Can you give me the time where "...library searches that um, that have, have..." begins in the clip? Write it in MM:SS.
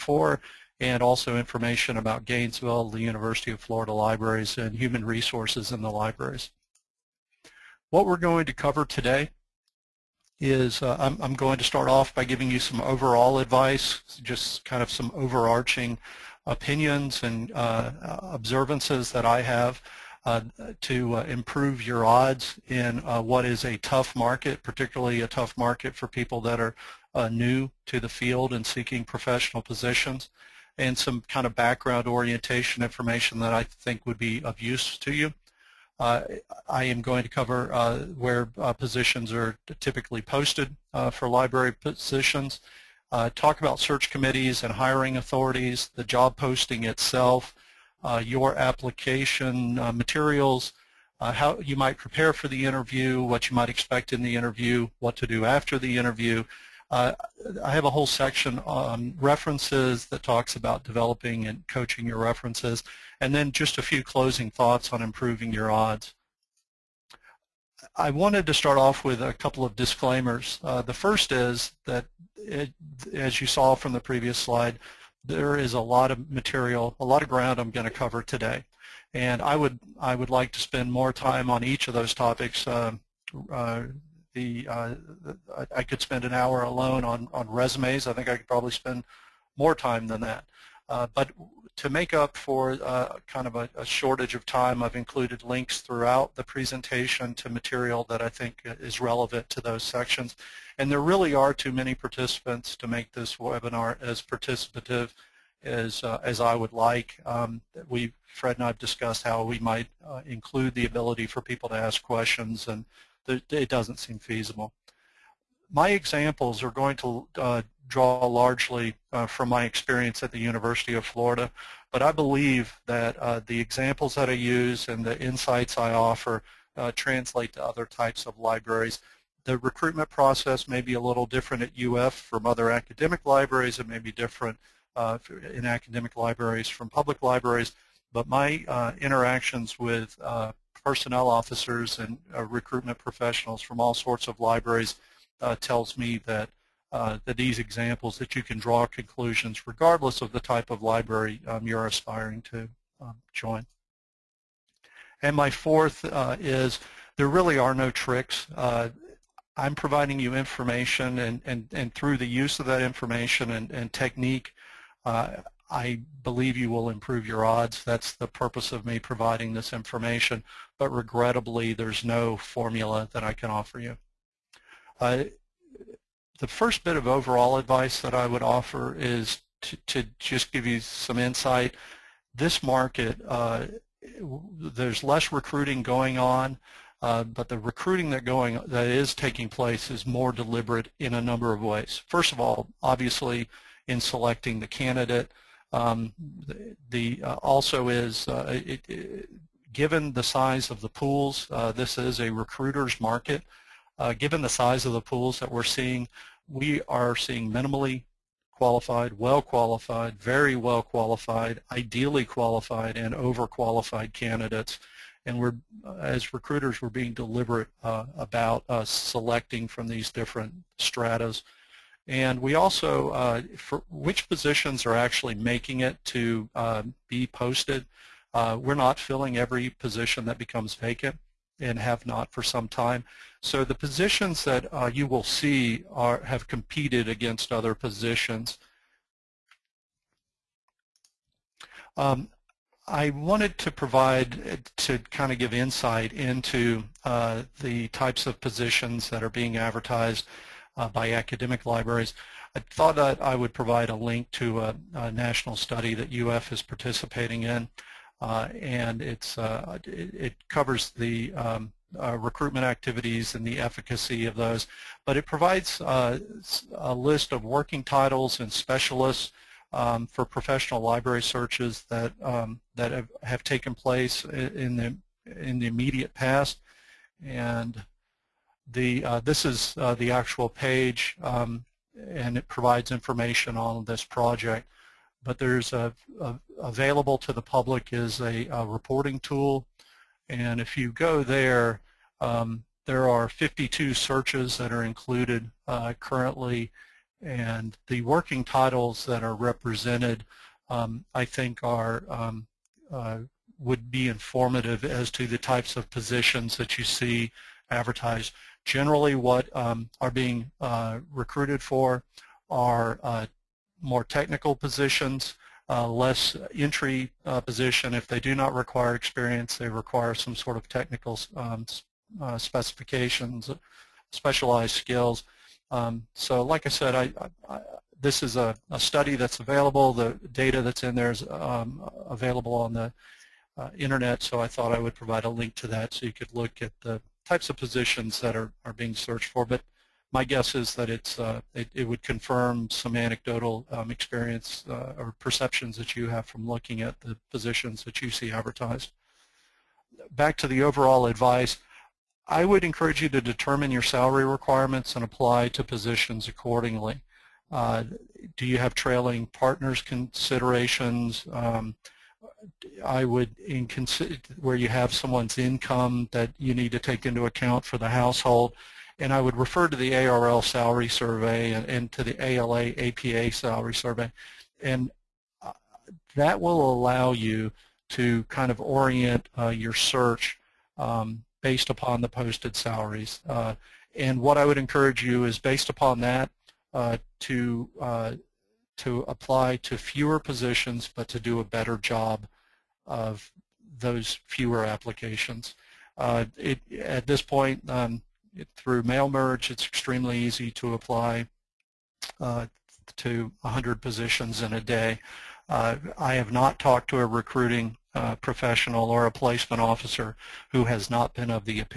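04:30.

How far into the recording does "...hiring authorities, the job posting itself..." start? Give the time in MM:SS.
00:44.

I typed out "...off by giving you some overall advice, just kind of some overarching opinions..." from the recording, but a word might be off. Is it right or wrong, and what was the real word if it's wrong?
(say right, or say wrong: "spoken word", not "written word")
right.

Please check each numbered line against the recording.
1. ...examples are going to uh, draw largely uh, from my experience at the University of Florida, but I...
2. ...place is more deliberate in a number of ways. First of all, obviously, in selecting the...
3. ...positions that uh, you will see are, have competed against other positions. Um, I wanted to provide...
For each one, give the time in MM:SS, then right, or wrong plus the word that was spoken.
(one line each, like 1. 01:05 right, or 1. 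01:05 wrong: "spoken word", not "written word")
1. 01:55 right
2. 03:09 right
3. 03:53 right.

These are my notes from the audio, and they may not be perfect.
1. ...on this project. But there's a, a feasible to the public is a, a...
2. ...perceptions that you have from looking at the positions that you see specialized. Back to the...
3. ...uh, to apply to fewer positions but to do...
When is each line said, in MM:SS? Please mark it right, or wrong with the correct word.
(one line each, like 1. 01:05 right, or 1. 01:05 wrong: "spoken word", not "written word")
1. 04:43 wrong: "available", not "feasible"
2. 05:45 wrong: "advertised", not "specialized"
3. 06:27 right.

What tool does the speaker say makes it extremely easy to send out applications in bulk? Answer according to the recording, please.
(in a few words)
mail merge.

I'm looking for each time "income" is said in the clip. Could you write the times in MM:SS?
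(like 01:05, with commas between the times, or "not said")
06:05.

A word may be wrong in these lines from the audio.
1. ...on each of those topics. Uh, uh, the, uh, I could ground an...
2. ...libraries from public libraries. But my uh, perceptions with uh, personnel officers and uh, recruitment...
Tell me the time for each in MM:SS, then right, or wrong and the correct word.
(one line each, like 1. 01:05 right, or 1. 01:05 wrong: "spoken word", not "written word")
1. 01:21 wrong: "spend", not "ground"
2. 02:16 wrong: "interactions", not "perceptions".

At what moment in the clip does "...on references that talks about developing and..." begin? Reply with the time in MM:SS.
00:58.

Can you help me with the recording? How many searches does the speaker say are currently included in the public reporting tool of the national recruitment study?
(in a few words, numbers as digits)
52.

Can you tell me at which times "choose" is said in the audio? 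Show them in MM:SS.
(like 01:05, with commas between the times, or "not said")
not said.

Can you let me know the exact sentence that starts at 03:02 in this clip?
This market, uh, there's less recruiting going on.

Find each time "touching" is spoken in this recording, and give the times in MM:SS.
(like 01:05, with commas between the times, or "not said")
not said.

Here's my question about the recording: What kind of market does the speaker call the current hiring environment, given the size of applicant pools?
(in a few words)
a recruiter's market.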